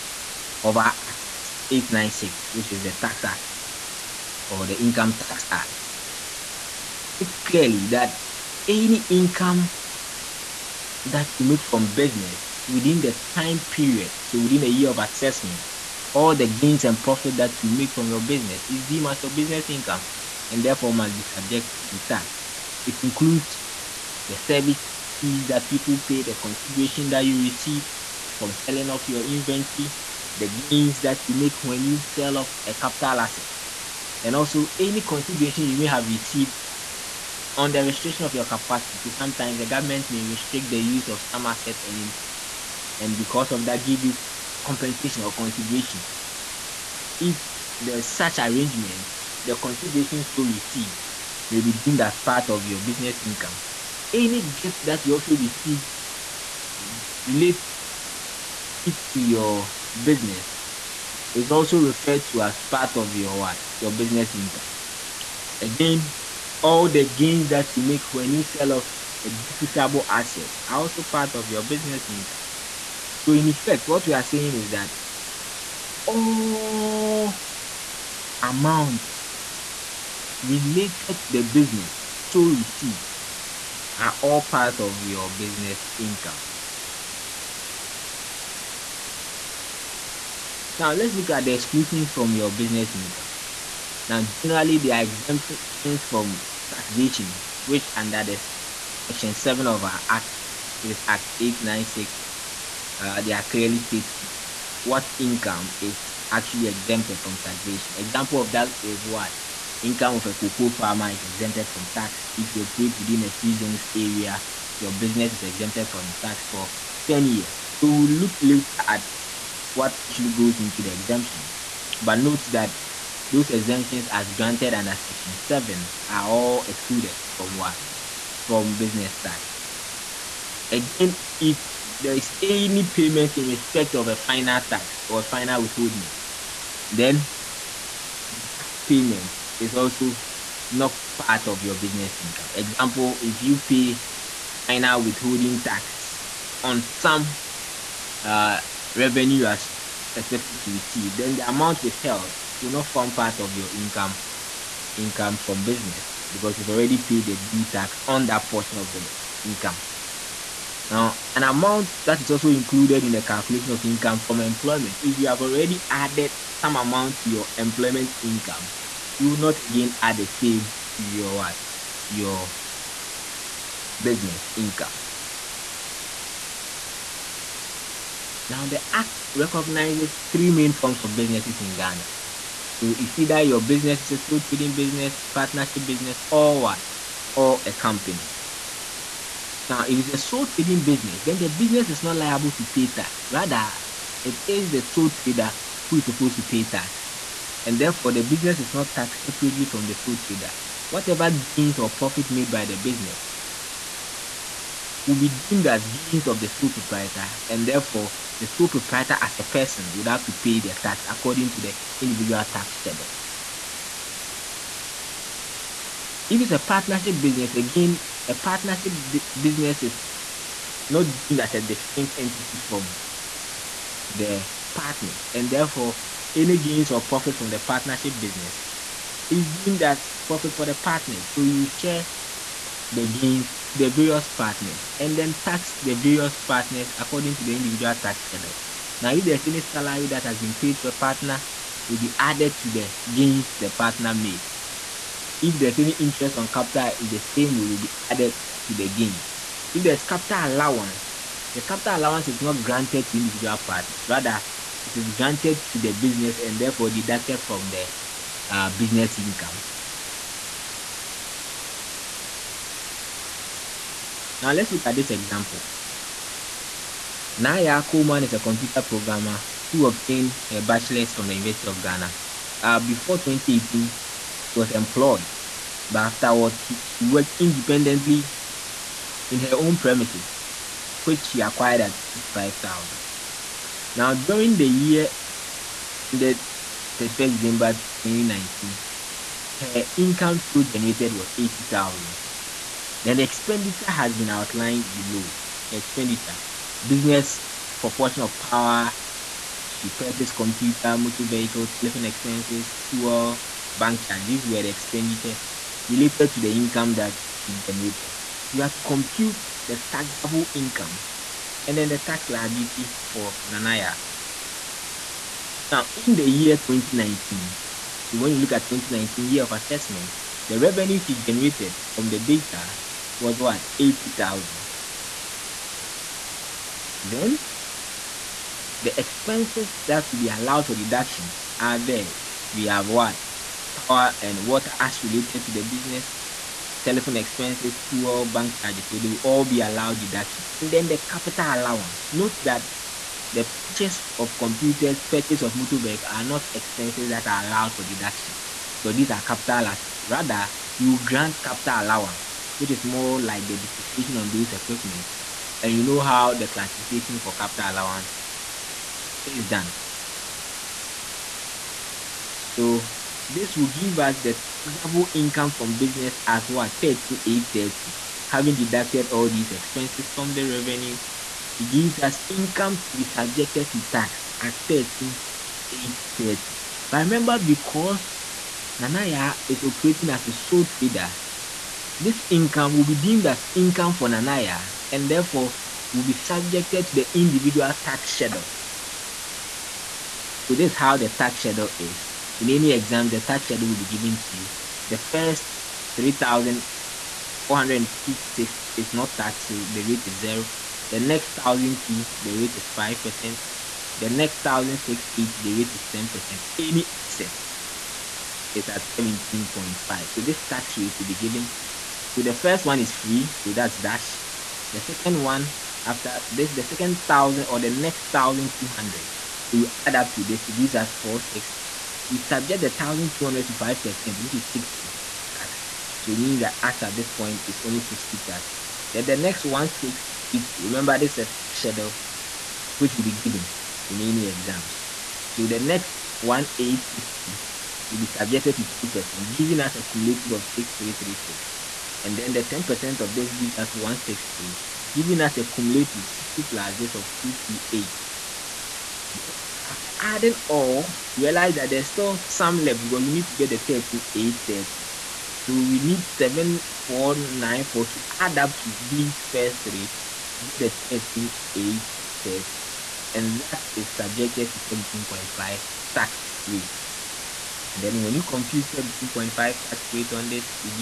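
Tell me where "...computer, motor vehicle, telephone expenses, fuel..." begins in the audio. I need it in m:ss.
5:00.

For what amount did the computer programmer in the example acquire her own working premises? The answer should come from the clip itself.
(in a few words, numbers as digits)
65,000.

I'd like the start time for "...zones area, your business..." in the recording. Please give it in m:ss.
1:53.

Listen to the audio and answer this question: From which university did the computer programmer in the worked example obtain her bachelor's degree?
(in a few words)
University of Ghana.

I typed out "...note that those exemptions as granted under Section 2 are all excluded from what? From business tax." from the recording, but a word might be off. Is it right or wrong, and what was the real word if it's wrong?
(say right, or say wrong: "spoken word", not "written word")
wrong: "7", not "2".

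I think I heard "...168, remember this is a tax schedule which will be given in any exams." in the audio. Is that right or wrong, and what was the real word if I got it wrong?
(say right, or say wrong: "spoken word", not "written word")
right.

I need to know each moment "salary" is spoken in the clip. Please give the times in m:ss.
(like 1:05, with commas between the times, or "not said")
3:59.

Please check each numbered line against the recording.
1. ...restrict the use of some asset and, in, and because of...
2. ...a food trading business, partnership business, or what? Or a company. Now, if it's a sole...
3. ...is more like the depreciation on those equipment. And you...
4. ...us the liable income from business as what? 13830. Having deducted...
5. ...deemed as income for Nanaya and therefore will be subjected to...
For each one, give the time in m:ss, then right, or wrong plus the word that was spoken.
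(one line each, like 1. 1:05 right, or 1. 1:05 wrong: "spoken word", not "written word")
1. 0:40 right
2. 3:04 right
3. 5:52 right
4. 6:03 wrong: "taxable", not "liable"
5. 6:22 right.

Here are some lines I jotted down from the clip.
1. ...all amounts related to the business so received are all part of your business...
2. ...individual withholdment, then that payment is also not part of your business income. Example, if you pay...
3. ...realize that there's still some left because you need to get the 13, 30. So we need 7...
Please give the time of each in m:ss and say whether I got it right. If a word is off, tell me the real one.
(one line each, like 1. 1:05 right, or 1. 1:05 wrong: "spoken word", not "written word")
1. 1:16 right
2. 2:15 wrong: "final", not "individual"
3. 7:31 right.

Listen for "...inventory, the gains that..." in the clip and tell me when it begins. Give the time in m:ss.
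0:29.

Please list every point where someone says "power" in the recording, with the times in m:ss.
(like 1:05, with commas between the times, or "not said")
4:58, 5:33.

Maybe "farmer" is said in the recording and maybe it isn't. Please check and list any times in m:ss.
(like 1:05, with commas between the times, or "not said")
1:50.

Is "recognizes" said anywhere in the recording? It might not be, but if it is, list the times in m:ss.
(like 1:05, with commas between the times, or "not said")
2:59.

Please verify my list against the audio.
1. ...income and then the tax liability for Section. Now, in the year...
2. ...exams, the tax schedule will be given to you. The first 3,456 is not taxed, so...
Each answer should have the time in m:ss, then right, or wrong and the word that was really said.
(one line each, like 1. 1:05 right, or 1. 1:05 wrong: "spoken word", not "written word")
1. 5:10 wrong: "Nanaya", not "Section"
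2. 6:32 right.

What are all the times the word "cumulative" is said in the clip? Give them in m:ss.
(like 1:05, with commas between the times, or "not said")
7:19, 7:25.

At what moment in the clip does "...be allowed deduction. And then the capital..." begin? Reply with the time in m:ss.
5:39.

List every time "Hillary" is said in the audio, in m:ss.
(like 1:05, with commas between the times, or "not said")
not said.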